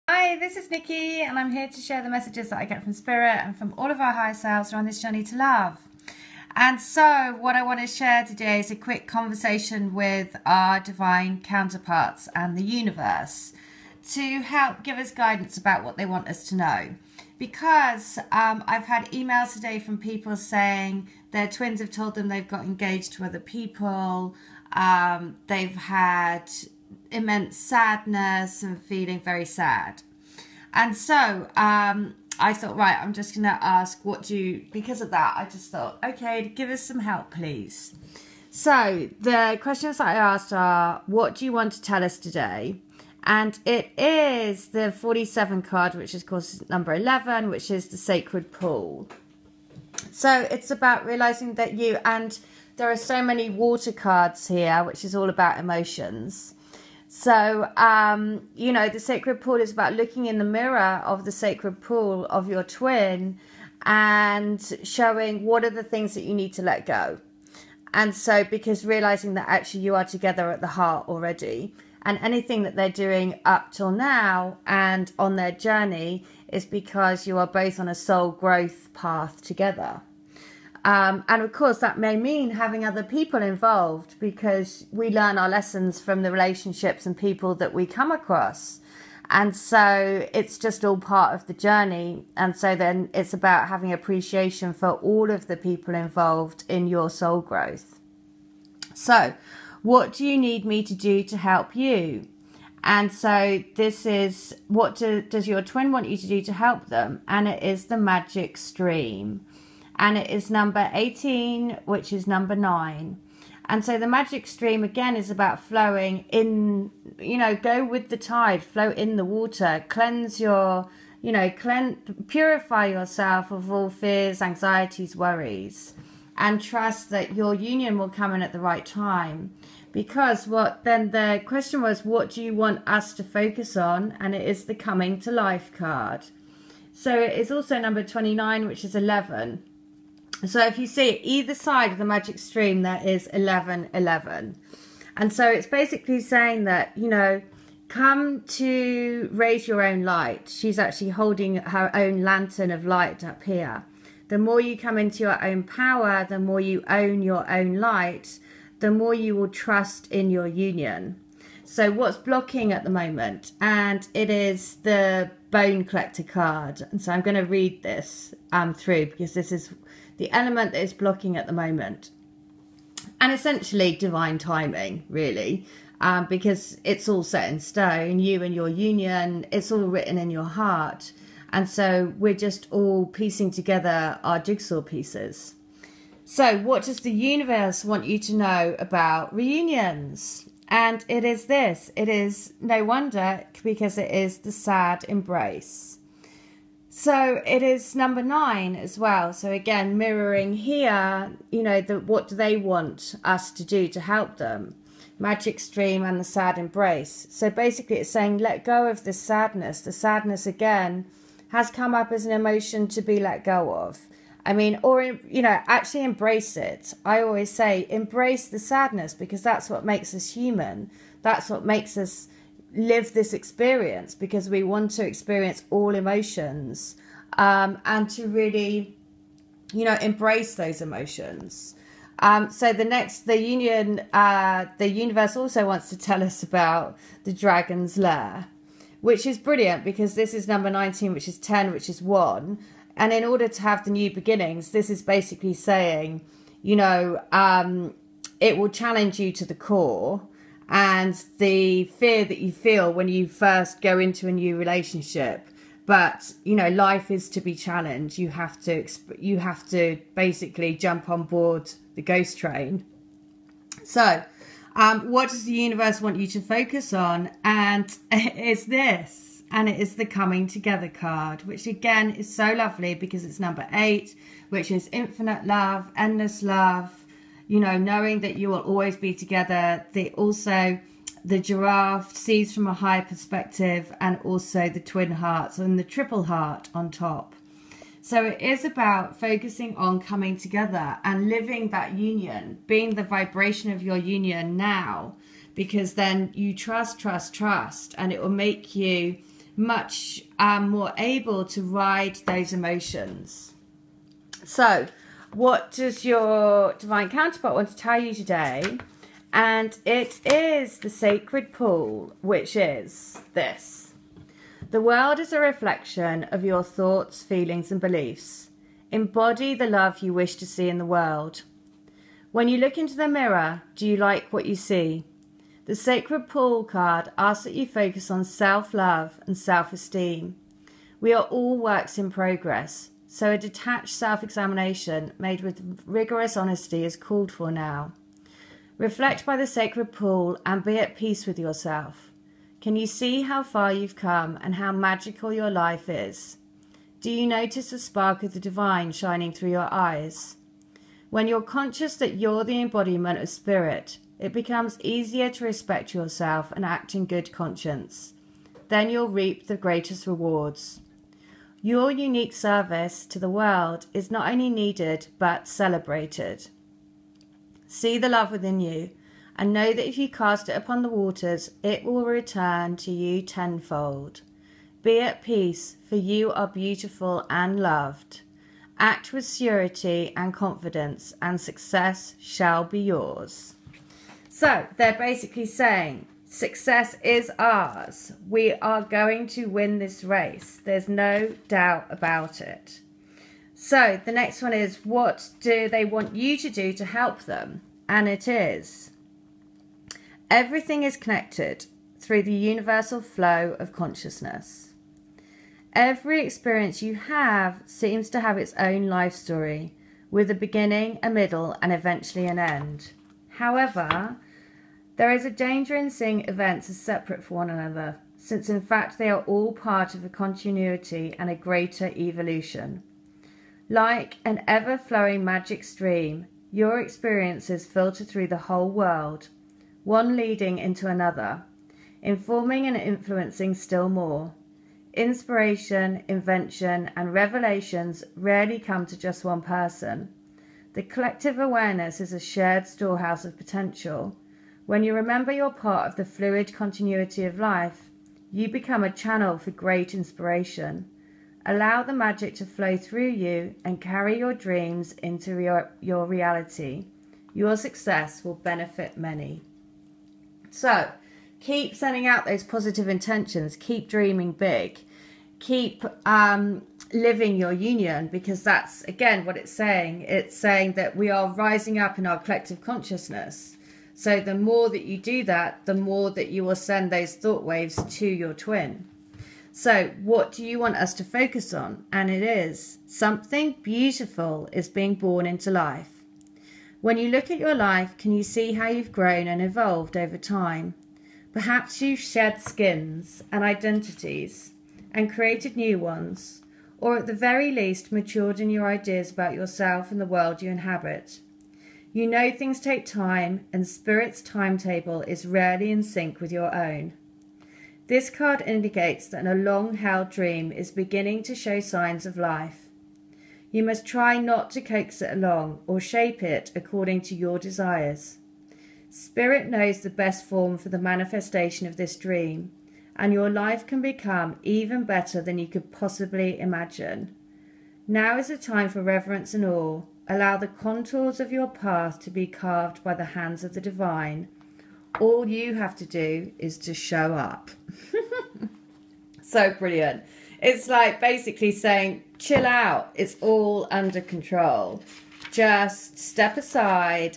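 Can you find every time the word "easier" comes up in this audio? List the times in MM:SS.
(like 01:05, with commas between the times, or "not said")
05:54.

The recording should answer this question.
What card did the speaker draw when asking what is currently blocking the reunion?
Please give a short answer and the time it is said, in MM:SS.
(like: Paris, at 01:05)
The bone collector, at 02:45.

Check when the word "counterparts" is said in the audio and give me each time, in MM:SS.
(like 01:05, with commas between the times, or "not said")
00:11, 05:07.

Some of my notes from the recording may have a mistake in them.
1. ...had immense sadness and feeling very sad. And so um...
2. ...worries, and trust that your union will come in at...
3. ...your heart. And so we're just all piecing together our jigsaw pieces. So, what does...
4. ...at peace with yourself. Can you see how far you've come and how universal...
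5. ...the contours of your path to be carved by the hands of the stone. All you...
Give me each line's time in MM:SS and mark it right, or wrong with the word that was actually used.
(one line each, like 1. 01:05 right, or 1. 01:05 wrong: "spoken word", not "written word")
1. 00:25 right
2. 02:05 right
3. 03:00 right
4. 05:40 wrong: "magical", not "universal"
5. 08:50 wrong: "divine", not "stone".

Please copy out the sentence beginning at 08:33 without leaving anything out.
You must try not to coax it along or shape it according to your desires.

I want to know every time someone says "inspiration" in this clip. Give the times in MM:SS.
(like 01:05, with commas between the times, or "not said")
07:14, 07:29.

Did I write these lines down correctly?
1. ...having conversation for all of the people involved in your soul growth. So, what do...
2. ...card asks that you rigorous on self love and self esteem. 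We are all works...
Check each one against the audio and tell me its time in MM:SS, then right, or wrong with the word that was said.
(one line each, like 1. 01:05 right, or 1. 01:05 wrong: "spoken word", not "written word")
1. 01:33 wrong: "appreciation", not "conversation"
2. 05:26 wrong: "focus", not "rigorous".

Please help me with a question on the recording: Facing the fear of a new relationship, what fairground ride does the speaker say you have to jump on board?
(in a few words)
The ghost train.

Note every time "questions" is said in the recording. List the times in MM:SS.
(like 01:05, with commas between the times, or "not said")
00:39, 02:11.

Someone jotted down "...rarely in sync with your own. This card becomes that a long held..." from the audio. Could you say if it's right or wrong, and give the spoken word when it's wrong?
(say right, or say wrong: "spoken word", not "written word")
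wrong: "indicates", not "becomes".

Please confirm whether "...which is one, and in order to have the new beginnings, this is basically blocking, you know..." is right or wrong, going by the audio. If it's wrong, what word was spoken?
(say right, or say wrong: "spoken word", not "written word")
wrong: "saying", not "blocking".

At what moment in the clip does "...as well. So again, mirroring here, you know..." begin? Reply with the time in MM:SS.
03:18.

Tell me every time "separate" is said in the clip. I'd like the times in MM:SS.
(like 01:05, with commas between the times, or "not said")
06:56.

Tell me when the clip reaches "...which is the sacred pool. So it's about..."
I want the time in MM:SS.
00:47.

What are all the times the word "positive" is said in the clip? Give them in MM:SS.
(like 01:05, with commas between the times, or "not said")
07:42.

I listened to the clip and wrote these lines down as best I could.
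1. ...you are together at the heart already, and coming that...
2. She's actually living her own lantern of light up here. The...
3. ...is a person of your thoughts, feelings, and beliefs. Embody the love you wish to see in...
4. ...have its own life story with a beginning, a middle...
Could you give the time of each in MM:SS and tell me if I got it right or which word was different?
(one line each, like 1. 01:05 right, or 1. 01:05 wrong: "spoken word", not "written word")
1. 01:09 wrong: "anything", not "coming"
2. 02:30 wrong: "holding", not "living"
3. 05:15 wrong: "reflection", not "person"
4. 06:48 right.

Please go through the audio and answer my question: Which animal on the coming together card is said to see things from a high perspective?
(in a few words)
Giraffe.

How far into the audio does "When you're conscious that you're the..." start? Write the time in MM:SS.
05:51.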